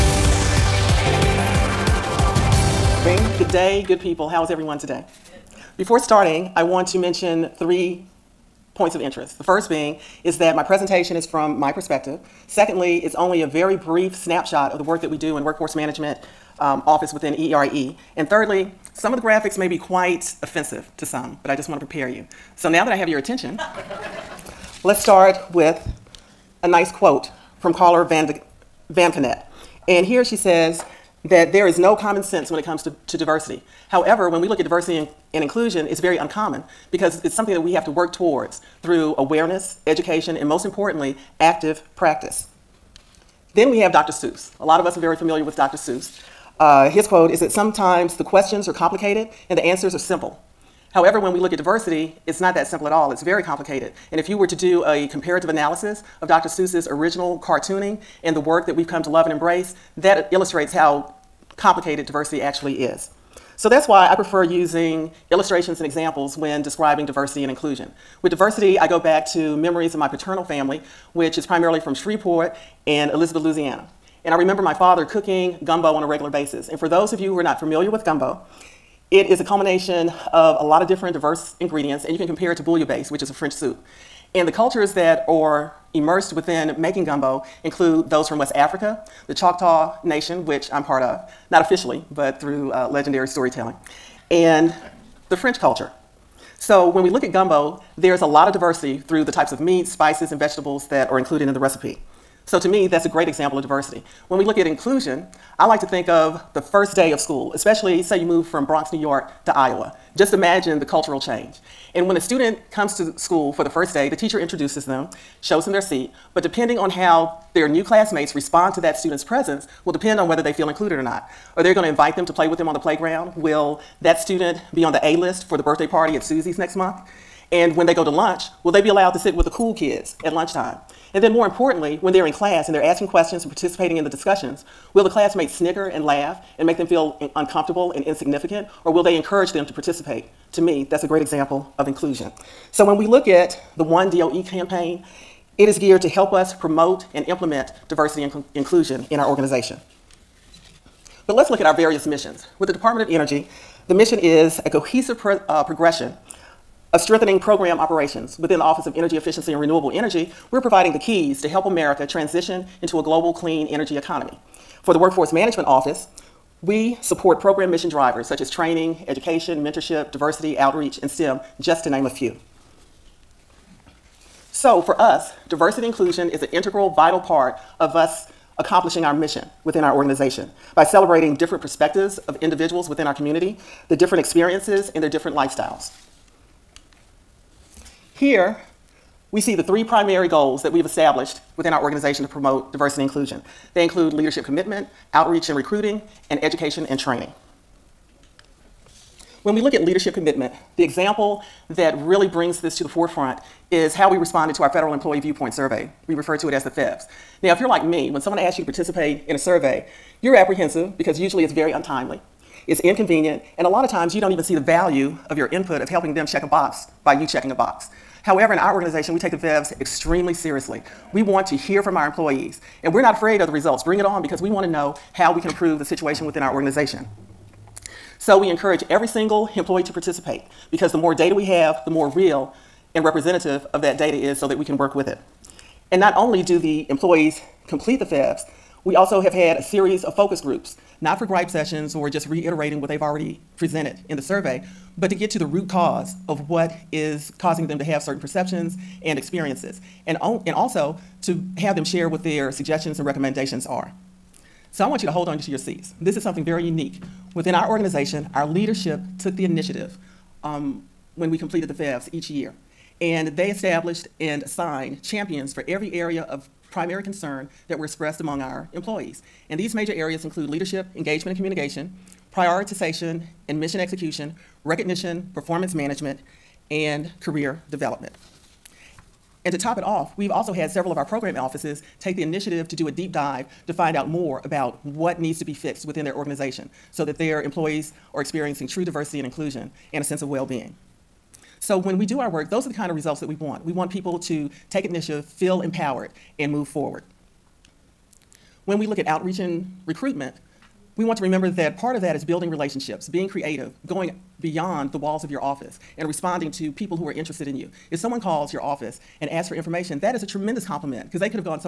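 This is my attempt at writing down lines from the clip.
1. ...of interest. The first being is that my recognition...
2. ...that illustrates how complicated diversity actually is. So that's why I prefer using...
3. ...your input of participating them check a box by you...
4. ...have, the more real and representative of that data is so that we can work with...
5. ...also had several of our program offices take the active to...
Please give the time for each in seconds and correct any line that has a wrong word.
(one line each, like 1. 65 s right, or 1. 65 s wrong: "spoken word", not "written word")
1. 8 s wrong: "presentation", not "recognition"
2. 59 s right
3. 215 s wrong: "helping", not "participating"
4. 231 s right
5. 280 s wrong: "initiative", not "active".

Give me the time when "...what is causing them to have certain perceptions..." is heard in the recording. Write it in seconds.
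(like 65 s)
246 s.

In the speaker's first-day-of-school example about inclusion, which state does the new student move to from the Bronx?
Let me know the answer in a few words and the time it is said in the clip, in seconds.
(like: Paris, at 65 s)
Iowa, at 109 s.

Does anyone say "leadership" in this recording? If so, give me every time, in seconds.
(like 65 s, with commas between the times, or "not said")
194 s, 199 s, 258 s, 270 s.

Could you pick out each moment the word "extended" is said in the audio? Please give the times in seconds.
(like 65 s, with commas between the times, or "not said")
not said.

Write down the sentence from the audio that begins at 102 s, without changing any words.
So to me, that's a great example of diversity.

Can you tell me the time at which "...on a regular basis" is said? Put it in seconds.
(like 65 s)
75 s.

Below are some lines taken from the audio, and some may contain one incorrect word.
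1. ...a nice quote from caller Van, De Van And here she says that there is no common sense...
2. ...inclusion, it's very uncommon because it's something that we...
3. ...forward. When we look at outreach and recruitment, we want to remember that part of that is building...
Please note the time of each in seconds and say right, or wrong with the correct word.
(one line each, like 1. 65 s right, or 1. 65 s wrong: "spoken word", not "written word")
1. 26 s right
2. 35 s right
3. 296 s right.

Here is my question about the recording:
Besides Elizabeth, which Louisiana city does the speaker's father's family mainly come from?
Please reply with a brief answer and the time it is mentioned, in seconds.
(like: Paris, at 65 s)
Shreveport, at 71 s.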